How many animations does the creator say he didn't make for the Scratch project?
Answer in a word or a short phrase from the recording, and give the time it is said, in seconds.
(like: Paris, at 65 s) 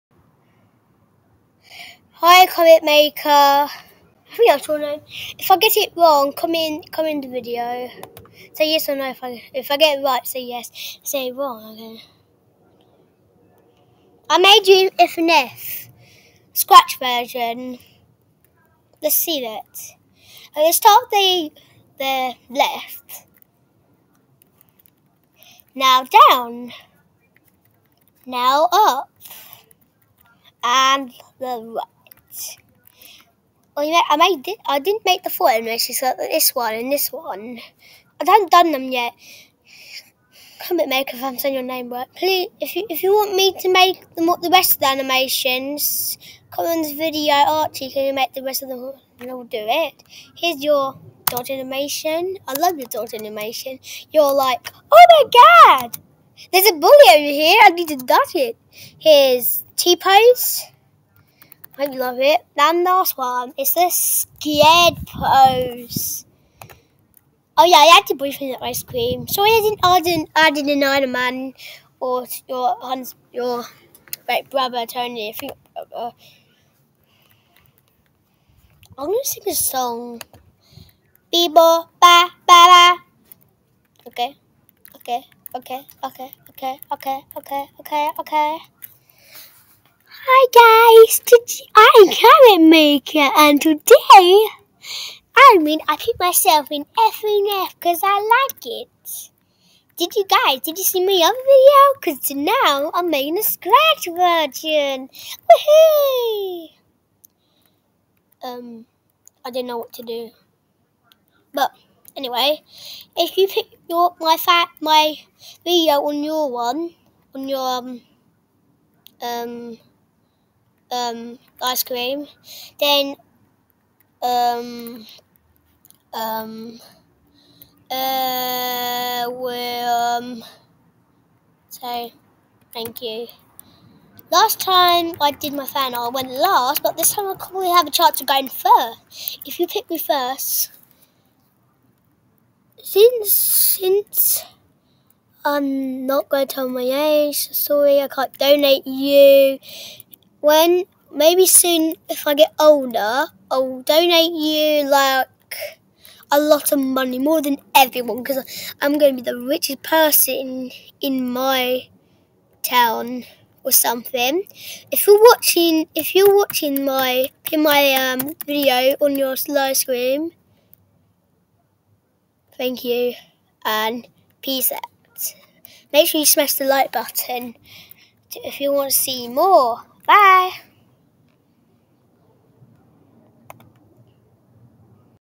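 4, at 35 s.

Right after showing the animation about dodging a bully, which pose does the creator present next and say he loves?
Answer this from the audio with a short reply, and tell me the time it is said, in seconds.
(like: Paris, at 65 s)
T-pose, at 59 s.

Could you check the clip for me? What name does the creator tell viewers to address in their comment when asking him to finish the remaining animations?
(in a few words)
Archie.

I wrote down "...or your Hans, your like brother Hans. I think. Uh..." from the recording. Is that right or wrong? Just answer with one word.
wrong.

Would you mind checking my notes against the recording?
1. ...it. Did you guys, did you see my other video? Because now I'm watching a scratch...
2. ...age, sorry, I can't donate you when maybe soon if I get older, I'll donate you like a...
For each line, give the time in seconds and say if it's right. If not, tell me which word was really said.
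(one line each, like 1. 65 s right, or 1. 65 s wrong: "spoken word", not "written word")
1. 98 s wrong: "making", not "watching"
2. 146 s right.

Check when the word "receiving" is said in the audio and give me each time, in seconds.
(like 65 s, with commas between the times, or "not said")
not said.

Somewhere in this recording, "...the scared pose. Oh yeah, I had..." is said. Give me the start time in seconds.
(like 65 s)
63 s.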